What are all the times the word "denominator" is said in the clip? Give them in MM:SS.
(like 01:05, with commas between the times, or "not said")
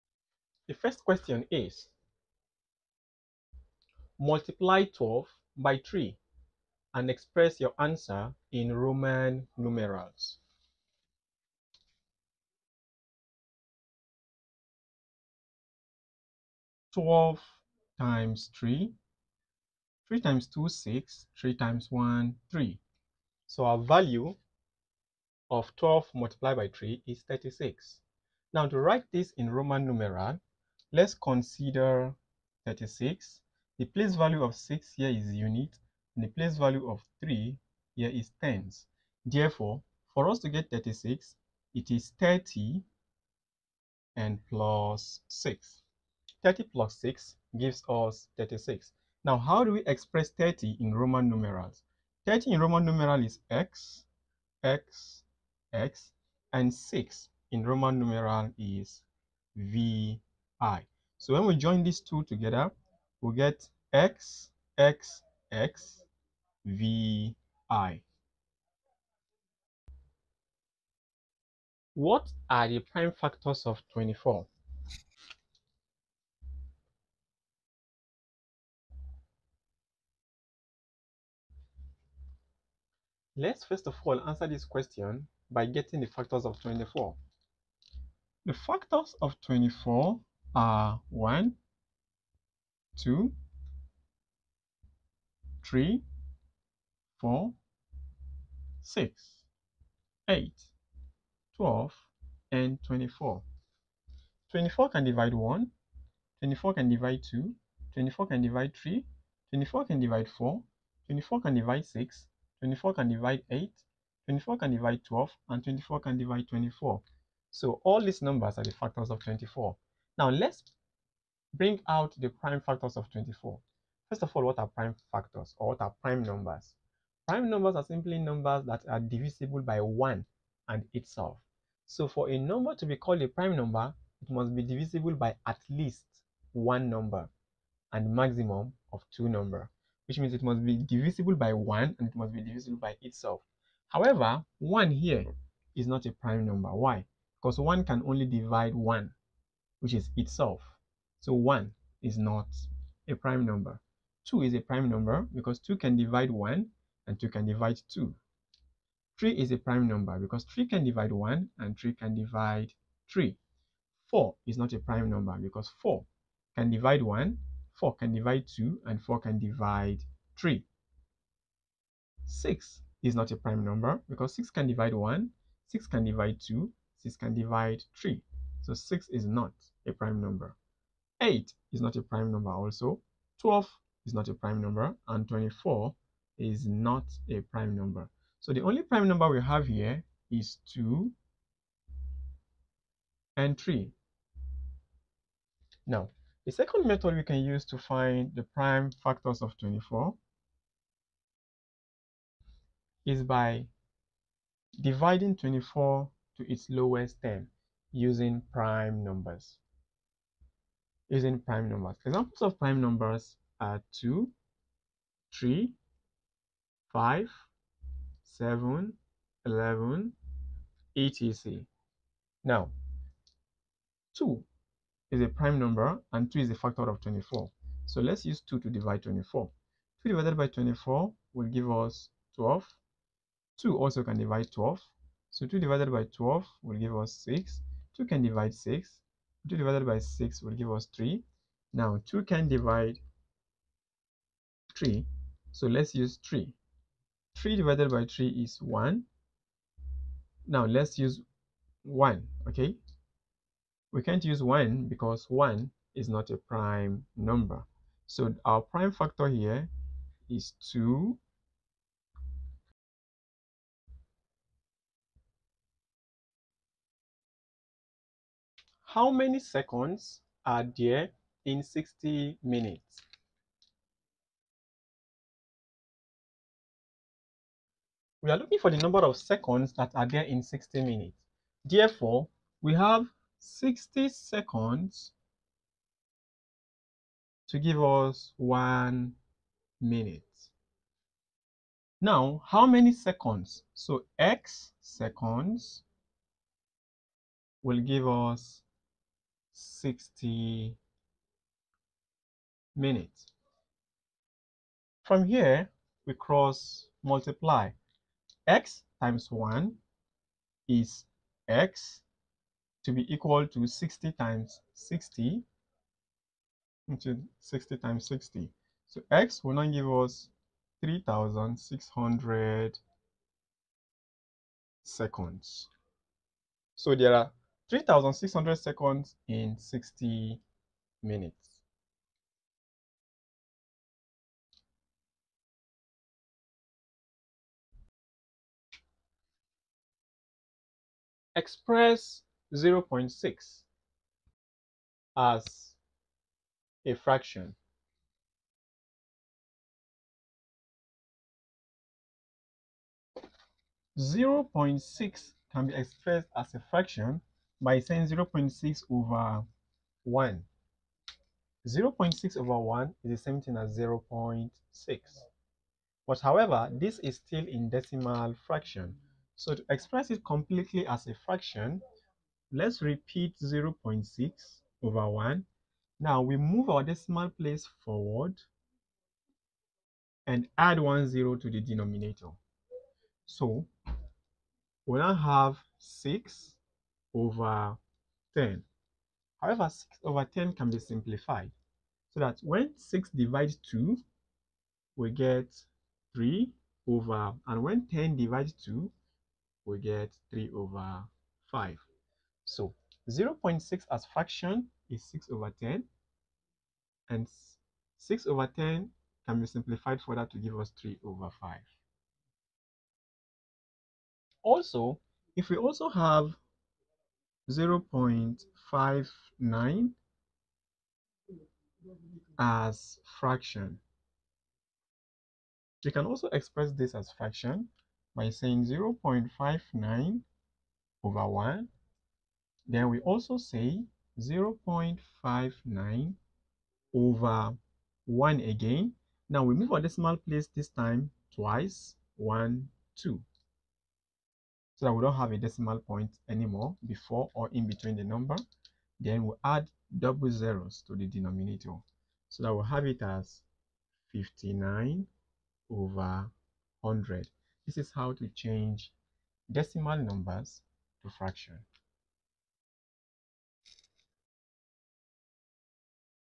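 06:21, 07:31.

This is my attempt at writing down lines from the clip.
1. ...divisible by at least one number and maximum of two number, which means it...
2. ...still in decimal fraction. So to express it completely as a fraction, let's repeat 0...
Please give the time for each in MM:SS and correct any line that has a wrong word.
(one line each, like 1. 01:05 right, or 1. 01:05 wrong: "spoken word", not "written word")
1. 02:14 right
2. 06:07 right.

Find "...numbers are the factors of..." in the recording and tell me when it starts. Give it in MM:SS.
01:58.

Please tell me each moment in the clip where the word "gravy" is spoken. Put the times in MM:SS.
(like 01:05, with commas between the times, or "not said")
not said.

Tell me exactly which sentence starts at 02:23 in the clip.
However, 1 here is not a prime number.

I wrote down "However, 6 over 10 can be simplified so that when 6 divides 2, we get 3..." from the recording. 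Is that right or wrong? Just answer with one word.
right.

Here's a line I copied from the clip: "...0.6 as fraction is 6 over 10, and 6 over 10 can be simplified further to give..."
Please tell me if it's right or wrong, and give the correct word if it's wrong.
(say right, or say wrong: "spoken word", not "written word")
right.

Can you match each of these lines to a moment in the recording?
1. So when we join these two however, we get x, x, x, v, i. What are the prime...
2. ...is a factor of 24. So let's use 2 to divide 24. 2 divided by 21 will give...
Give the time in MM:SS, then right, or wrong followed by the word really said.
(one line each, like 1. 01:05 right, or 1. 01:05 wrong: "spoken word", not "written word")
1. 01:01 wrong: "together", not "however"
2. 03:46 wrong: "24", not "21".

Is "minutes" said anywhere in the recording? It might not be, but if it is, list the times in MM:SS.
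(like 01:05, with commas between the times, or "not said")
04:32, 04:40, 04:49, 05:02, 05:31.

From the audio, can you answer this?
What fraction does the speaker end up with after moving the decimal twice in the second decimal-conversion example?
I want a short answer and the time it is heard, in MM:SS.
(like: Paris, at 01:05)
59/100, at 07:34.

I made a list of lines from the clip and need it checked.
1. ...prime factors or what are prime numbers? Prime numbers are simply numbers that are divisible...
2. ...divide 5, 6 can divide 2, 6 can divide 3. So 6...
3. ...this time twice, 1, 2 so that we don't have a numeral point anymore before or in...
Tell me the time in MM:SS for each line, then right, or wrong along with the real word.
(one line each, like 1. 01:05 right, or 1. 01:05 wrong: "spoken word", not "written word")
1. 02:04 right
2. 02:54 wrong: "1", not "5"
3. 07:20 wrong: "decimal", not "numeral".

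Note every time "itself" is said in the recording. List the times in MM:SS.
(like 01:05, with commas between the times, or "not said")
02:10, 02:23, 02:30.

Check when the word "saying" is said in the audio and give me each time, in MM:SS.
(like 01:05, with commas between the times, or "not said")
05:57, 07:08.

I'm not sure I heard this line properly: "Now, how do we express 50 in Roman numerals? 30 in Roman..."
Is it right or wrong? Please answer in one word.
wrong.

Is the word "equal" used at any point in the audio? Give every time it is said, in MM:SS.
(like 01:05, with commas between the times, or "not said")
05:13.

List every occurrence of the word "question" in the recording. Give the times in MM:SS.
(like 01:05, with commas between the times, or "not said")
00:01, 01:24.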